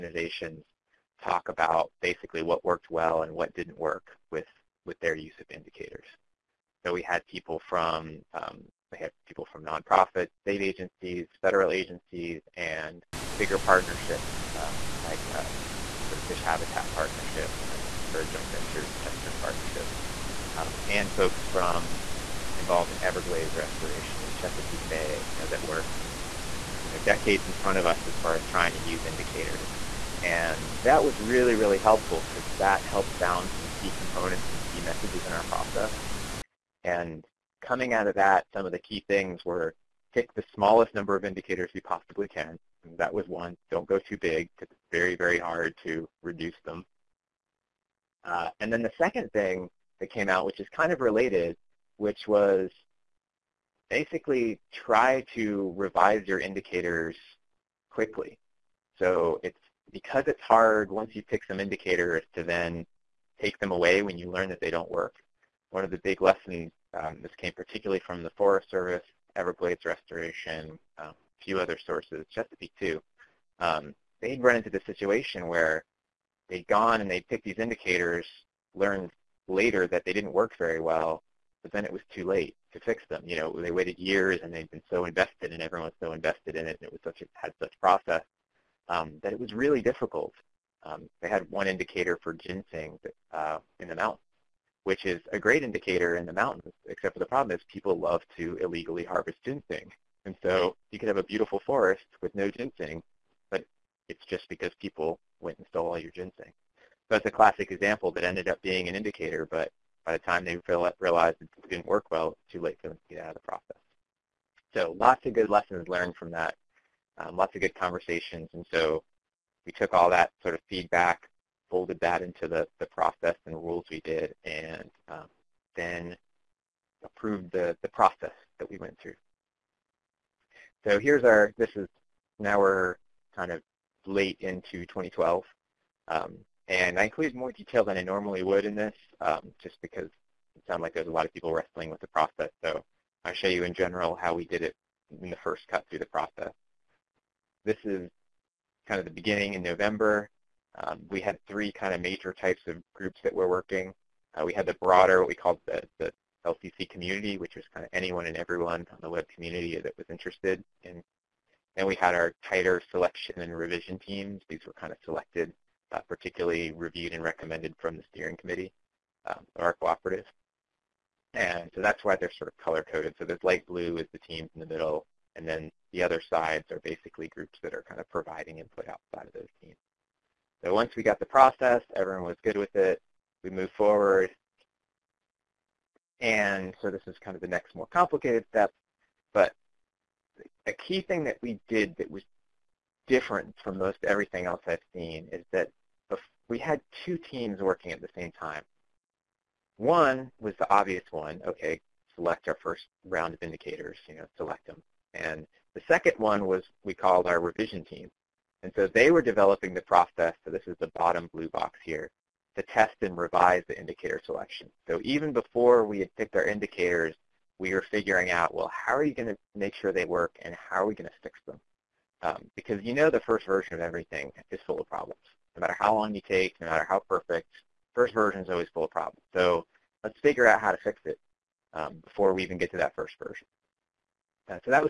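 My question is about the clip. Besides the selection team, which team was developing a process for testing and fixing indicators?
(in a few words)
Revision team.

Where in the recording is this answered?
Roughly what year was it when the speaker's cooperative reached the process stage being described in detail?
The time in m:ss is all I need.
2:14.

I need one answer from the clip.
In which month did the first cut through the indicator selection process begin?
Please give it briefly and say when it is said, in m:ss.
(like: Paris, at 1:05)
November, at 2:29.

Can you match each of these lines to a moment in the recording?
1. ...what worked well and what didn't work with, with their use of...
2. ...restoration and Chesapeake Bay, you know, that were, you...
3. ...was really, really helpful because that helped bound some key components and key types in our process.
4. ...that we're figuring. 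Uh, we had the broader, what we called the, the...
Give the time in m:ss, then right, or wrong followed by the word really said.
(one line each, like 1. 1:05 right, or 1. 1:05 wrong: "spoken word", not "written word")
1. 0:02 right
2. 0:23 right
3. 0:31 wrong: "messages", not "types"
4. 2:33 wrong: "working", not "figuring".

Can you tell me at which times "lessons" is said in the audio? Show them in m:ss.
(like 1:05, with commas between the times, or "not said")
1:06, 1:55.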